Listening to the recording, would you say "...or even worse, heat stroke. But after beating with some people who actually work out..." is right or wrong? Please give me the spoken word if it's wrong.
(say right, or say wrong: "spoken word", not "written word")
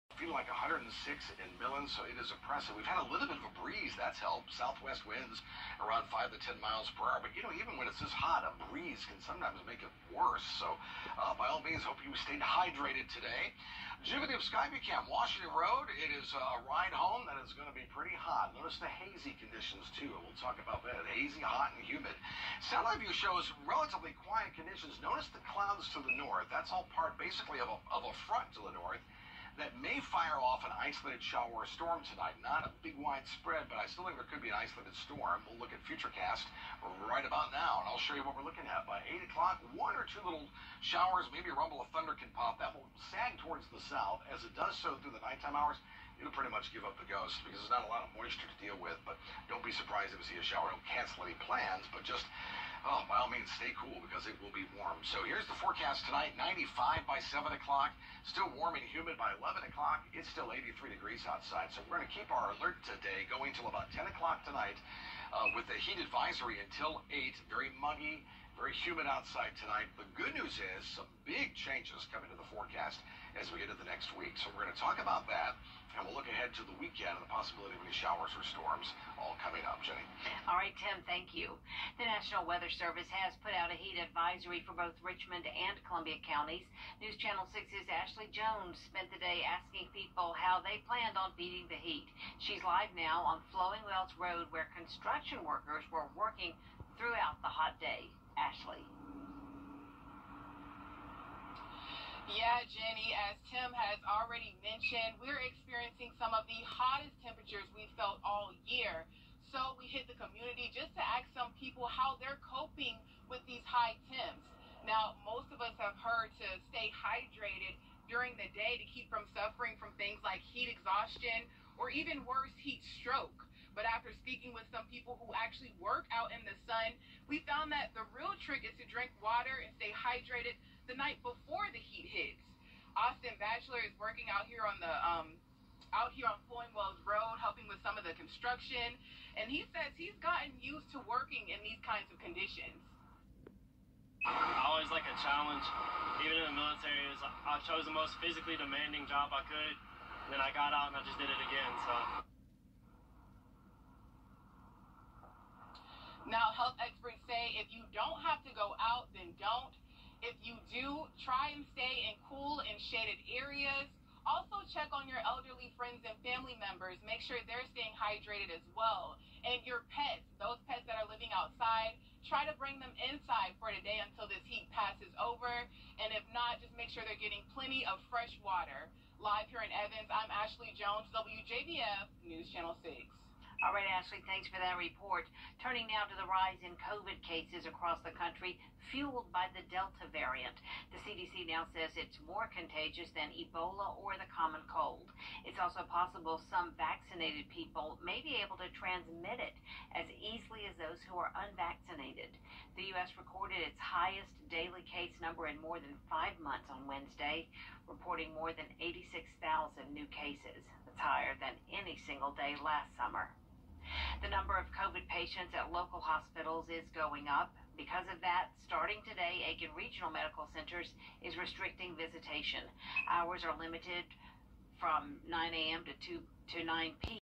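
wrong: "speaking", not "beating".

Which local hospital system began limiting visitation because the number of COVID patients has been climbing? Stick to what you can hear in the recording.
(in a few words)
Aiken Regional Medical Centers.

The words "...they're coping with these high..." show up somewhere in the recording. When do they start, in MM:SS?
01:52.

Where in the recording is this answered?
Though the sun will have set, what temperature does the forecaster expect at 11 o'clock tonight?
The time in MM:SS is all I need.
01:00.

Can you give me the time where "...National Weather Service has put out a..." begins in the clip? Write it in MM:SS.
01:22.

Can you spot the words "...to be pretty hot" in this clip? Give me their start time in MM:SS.
00:17.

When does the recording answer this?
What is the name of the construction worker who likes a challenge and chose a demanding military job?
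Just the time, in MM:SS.
02:12.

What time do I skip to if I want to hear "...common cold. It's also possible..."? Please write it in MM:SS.
03:14.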